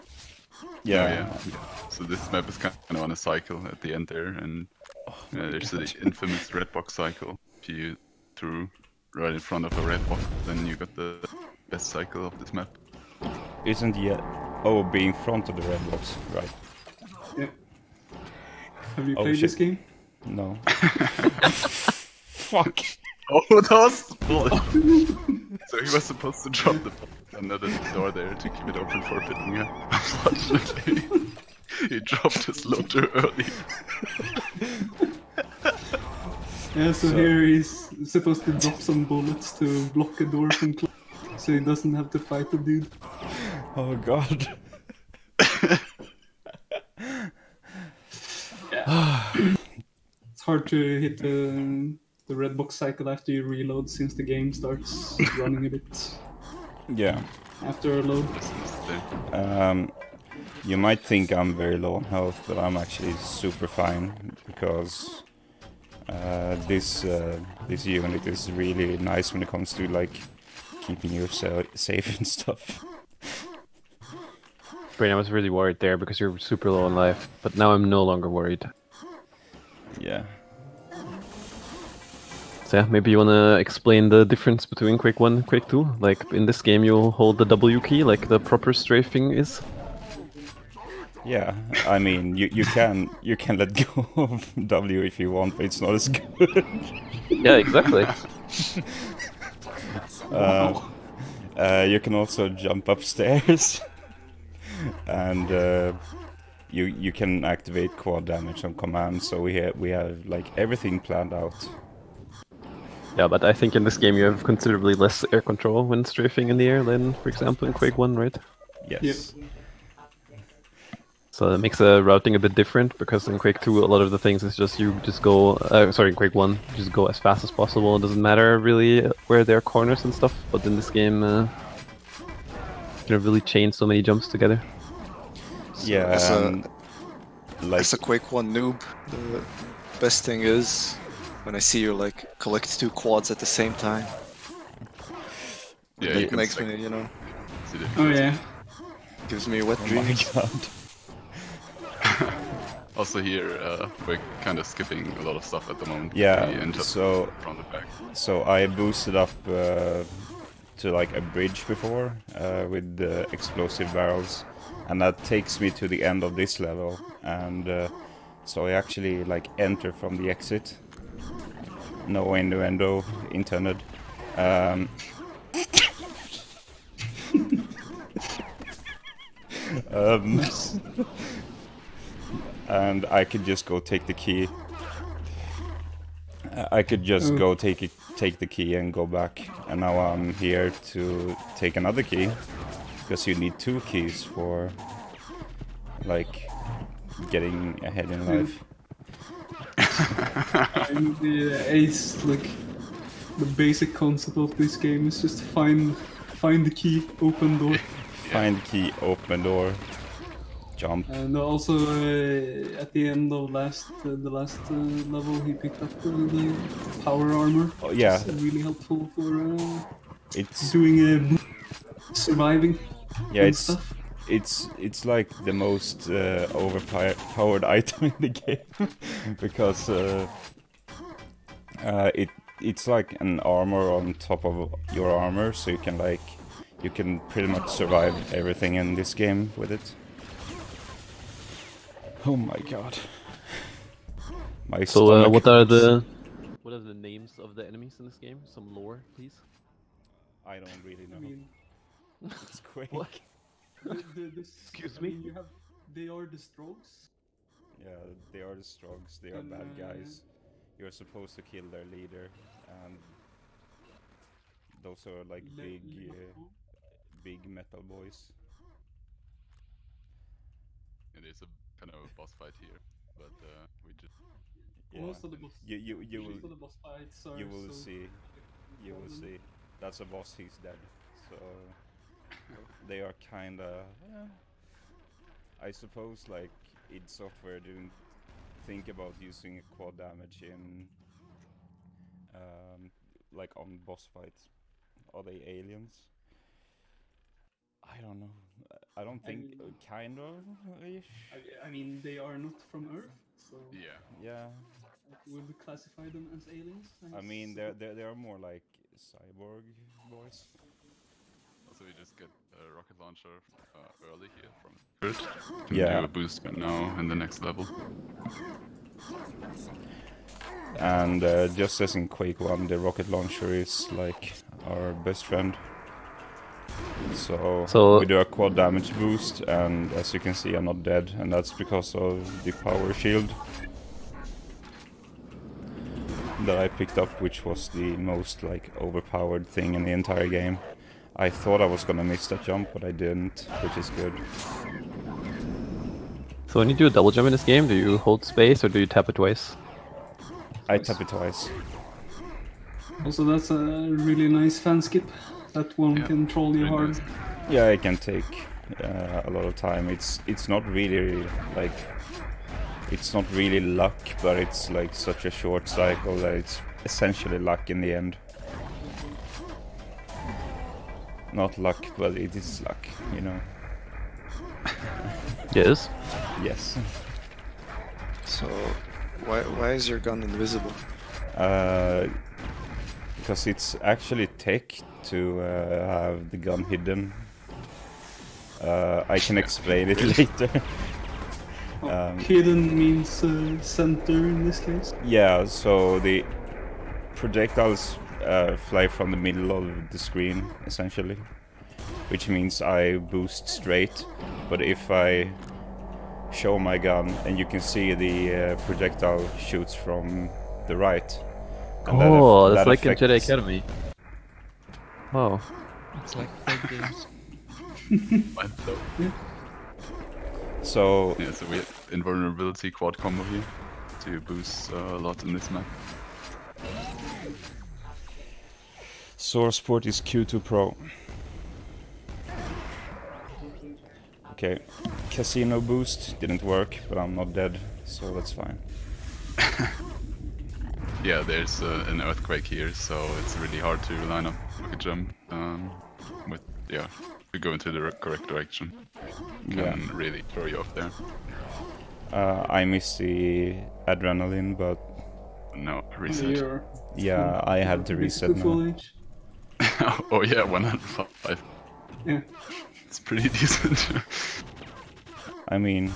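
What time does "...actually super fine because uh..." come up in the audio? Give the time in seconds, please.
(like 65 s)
62 s.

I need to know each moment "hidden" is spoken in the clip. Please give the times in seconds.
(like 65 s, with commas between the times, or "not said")
386 s, 392 s.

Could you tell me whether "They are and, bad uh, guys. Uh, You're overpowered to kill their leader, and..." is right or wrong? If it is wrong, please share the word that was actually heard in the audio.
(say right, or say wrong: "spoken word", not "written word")
wrong: "supposed", not "overpowered".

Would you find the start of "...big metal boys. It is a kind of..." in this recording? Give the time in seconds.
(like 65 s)
267 s.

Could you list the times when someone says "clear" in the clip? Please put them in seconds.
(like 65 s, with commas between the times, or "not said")
not said.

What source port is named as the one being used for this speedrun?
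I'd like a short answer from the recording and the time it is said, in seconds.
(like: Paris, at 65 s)
Q2PRO, at 430 s.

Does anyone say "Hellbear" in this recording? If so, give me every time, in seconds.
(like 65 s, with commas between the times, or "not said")
not said.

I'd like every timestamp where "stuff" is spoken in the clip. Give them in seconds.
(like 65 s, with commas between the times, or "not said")
72 s, 130 s, 155 s, 223 s.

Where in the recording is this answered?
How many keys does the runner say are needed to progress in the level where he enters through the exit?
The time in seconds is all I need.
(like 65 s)
193 s.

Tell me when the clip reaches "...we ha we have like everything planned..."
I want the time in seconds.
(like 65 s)
109 s.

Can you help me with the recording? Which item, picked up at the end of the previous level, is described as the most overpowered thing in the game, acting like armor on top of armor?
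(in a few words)
power armor.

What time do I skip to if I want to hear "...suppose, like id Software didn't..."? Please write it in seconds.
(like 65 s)
285 s.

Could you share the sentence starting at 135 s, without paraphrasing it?
Yeah, so as, a, um, like...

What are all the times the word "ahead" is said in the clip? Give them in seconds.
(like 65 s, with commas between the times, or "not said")
197 s.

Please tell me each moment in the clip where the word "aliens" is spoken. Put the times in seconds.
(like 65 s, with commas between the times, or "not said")
295 s, 306 s.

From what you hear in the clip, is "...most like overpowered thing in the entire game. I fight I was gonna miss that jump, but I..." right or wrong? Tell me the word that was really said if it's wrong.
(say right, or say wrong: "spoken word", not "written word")
wrong: "thought", not "fight".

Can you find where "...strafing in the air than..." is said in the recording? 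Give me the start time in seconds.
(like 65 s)
116 s.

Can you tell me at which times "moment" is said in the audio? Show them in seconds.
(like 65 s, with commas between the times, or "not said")
155 s.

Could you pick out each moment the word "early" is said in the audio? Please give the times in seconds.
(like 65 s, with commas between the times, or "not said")
33 s, 314 s.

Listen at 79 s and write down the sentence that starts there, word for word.
Yeah, so yeah, maybe you wanna explain the difference between Quake 1 and Quake 2?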